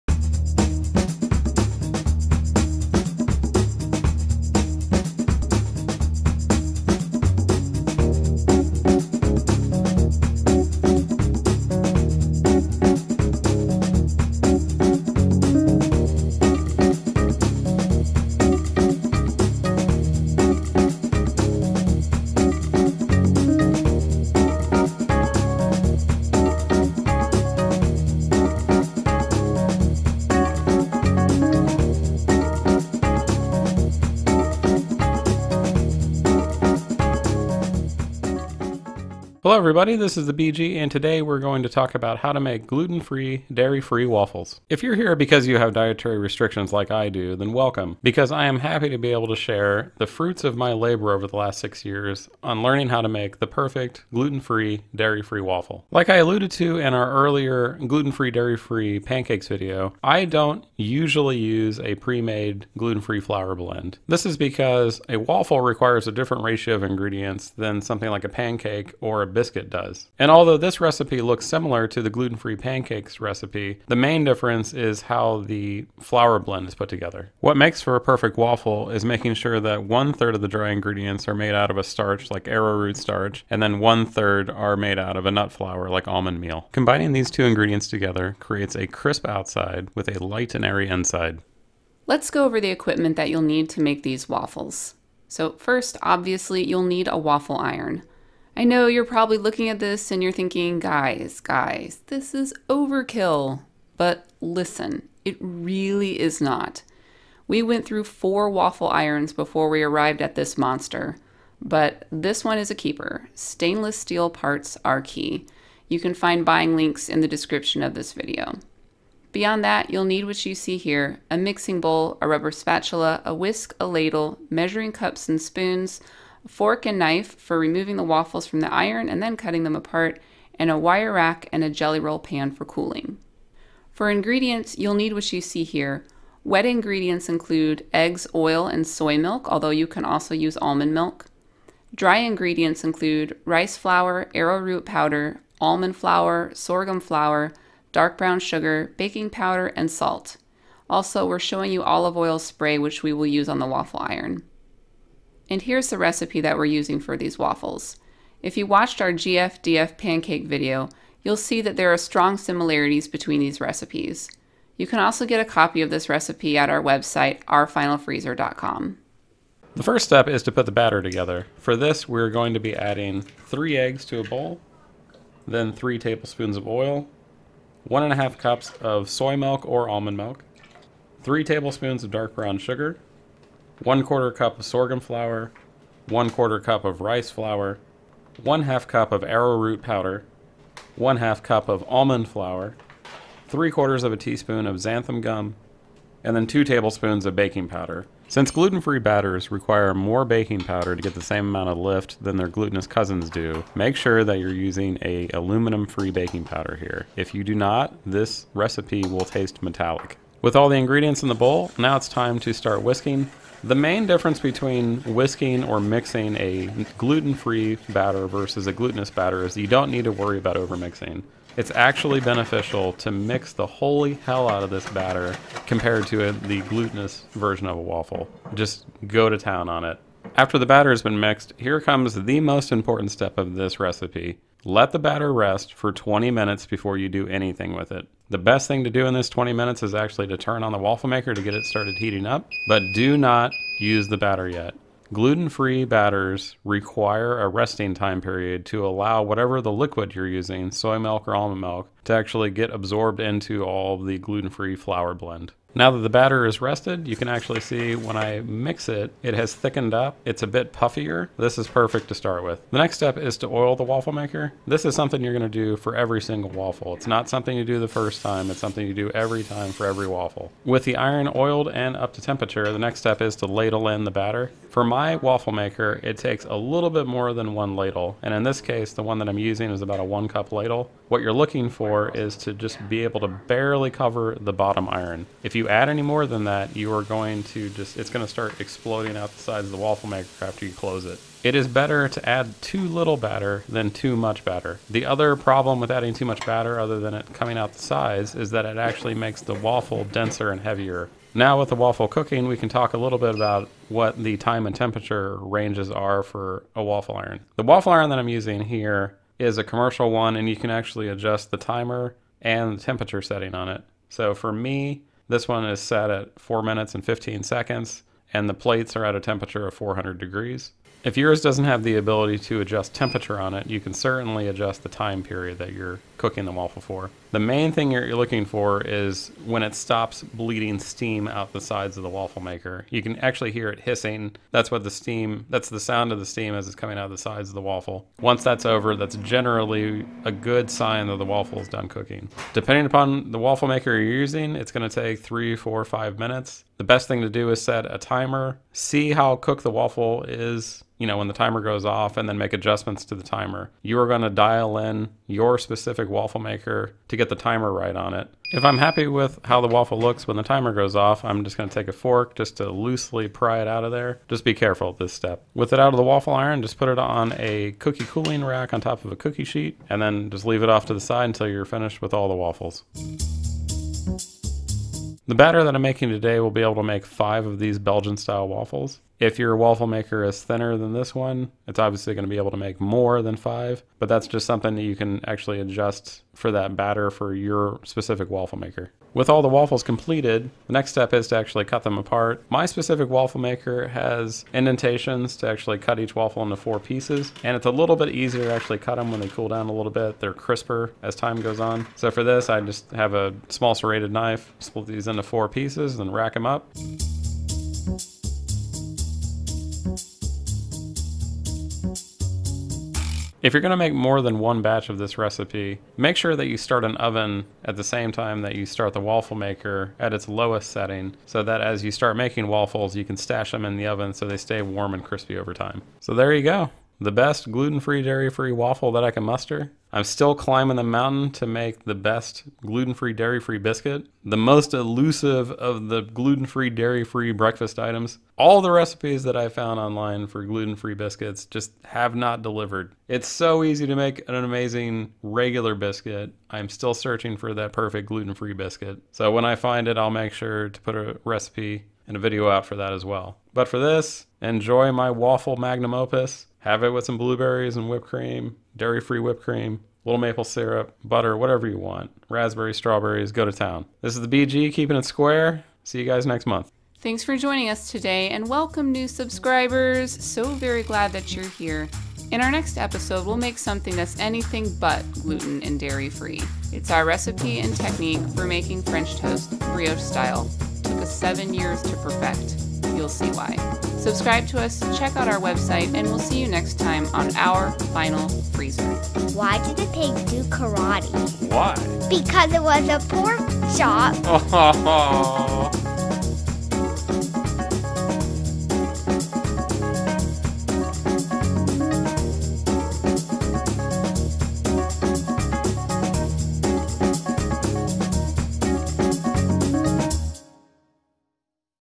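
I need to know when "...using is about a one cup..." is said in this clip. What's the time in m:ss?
4:39.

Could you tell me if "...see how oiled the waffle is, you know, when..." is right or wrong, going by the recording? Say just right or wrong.
wrong.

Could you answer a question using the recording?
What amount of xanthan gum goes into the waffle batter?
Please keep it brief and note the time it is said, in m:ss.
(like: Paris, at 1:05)
3/4 teaspoon, at 3:13.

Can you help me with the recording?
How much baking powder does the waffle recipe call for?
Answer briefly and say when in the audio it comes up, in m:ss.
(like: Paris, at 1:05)
2 tablespoons, at 3:16.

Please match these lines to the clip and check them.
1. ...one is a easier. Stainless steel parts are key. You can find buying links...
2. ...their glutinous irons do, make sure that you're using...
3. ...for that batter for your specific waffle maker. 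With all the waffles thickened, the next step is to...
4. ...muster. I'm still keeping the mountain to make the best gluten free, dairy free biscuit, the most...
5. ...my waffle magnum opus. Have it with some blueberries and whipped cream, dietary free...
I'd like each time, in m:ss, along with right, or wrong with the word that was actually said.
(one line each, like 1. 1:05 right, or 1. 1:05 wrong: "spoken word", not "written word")
1. 1:52 wrong: "keeper", not "easier"
2. 3:22 wrong: "cousins", not "irons"
3. 6:26 wrong: "completed", not "thickened"
4. 7:09 wrong: "climbing", not "keeping"
5. 7:34 wrong: "dairy", not "dietary".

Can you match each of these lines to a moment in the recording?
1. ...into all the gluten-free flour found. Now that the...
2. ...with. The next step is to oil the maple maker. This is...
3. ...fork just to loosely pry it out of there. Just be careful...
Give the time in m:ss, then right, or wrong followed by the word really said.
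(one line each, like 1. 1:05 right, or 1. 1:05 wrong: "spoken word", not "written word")
1. 4:13 wrong: "blend", not "found"
2. 4:22 wrong: "waffle", not "maple"
3. 6:01 right.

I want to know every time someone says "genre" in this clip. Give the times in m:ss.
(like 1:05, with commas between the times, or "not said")
not said.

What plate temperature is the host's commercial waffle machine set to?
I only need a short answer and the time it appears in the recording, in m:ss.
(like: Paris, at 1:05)
400 degrees, at 5:19.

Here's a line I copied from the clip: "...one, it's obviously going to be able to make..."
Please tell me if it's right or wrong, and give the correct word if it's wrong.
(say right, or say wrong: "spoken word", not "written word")
right.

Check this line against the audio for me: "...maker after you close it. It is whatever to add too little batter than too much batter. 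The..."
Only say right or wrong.
wrong.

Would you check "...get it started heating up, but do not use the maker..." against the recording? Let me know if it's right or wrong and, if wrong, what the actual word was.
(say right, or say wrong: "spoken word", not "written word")
wrong: "batter", not "maker".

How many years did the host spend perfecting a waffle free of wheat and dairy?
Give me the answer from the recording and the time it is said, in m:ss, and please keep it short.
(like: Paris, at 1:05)
6, at 0:51.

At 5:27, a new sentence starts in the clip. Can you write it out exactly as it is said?
The main thing you're looking for is when it stops bleeding steam out the sides of the waffle maker.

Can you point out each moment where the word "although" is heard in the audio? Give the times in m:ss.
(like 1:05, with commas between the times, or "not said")
1:10, 2:19.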